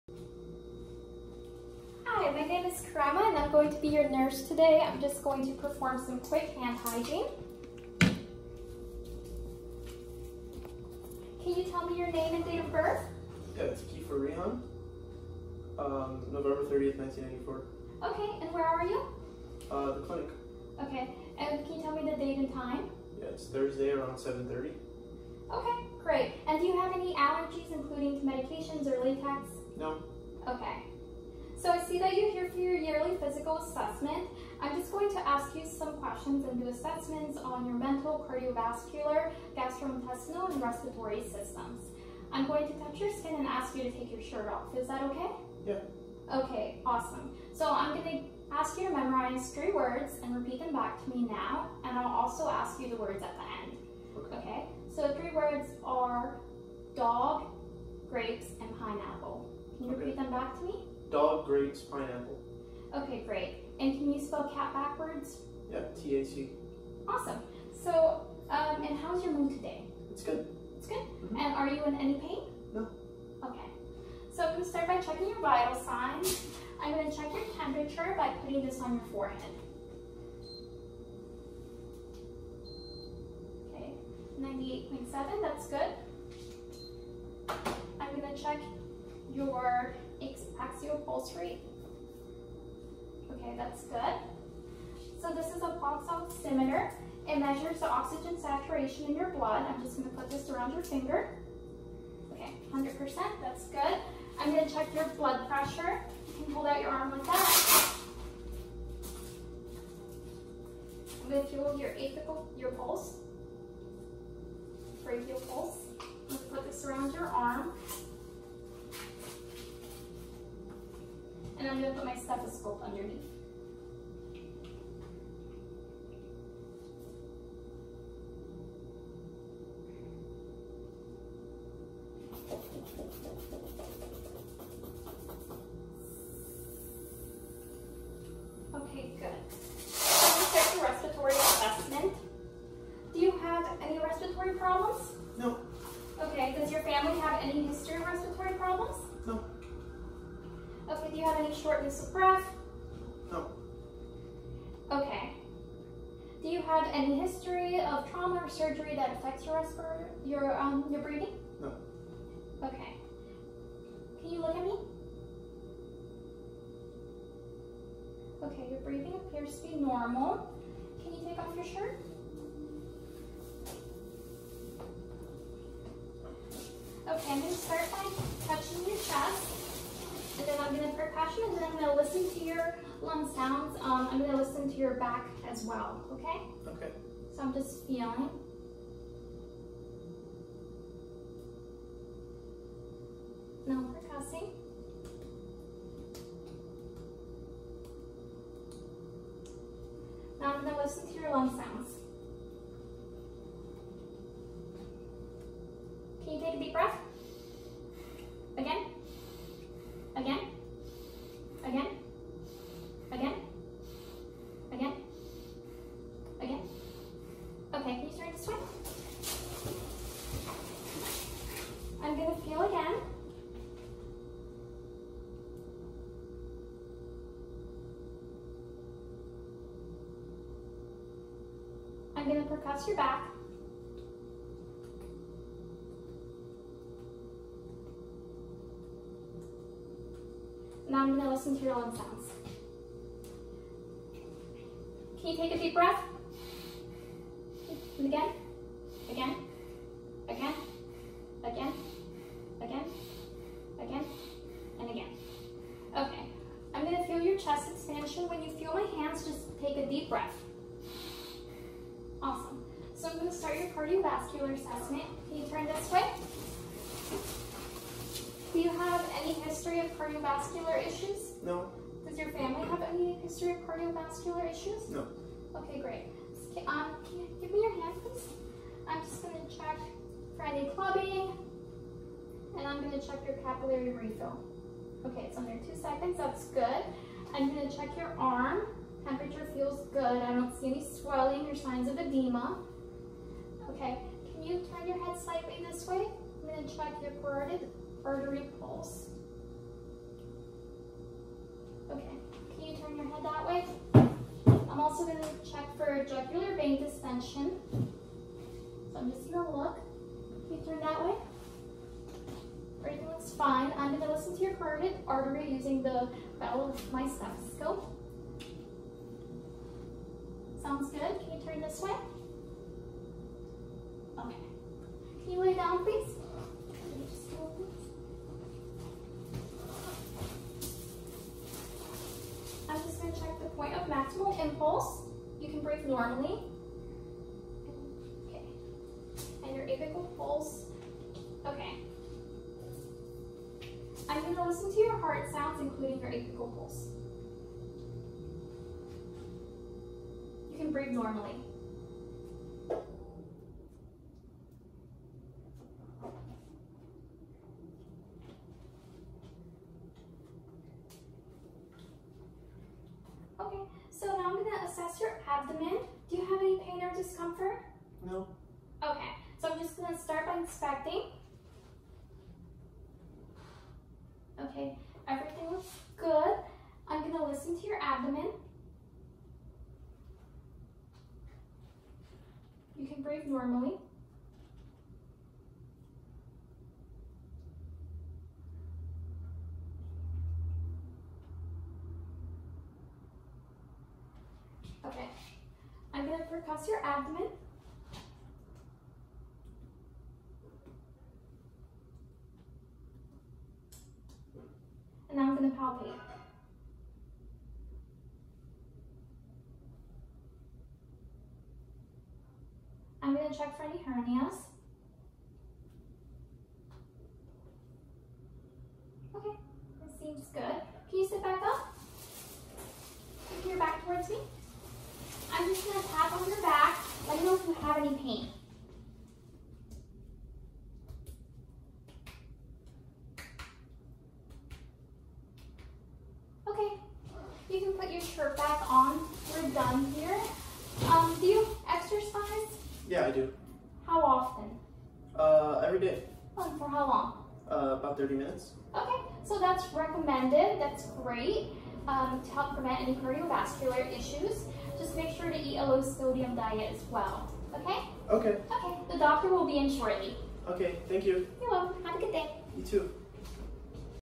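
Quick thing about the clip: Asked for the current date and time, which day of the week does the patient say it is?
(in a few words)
Thursday.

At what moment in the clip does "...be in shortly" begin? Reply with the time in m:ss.
7:39.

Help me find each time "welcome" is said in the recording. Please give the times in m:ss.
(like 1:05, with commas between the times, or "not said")
7:41.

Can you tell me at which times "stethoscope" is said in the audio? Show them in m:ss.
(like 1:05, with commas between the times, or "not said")
2:02, 5:17.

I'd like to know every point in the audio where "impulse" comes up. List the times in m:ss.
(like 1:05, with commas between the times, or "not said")
5:34.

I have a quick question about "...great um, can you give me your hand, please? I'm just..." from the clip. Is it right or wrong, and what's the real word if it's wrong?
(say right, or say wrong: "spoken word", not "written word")
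right.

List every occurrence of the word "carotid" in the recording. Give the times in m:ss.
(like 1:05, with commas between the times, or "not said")
4:57, 5:14.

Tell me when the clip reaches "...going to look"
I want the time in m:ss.
5:09.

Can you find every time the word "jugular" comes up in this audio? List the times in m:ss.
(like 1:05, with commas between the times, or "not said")
5:06.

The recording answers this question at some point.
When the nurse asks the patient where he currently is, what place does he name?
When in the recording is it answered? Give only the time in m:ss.
0:19.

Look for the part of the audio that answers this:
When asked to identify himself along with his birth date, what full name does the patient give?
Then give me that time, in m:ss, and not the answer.
0:13.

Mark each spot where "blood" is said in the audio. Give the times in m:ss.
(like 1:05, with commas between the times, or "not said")
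1:39, 1:45.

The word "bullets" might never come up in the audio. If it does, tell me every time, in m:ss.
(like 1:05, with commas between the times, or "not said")
not said.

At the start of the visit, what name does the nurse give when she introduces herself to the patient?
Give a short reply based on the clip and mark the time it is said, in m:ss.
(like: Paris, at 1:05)
Karama, at 0:02.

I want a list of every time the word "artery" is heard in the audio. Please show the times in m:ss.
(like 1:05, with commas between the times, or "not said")
4:58, 5:15.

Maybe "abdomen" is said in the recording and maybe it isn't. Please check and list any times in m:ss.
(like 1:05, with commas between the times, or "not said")
6:05, 6:17, 6:36.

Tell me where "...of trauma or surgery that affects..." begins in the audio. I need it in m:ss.
2:37.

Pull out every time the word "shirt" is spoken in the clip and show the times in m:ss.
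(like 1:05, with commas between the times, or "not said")
0:44, 2:51, 7:18.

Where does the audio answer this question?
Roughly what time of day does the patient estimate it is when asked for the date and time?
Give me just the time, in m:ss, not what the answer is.
0:24.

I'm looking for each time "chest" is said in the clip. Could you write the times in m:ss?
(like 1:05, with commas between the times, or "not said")
2:58, 4:17.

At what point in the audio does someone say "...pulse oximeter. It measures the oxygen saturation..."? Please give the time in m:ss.
1:35.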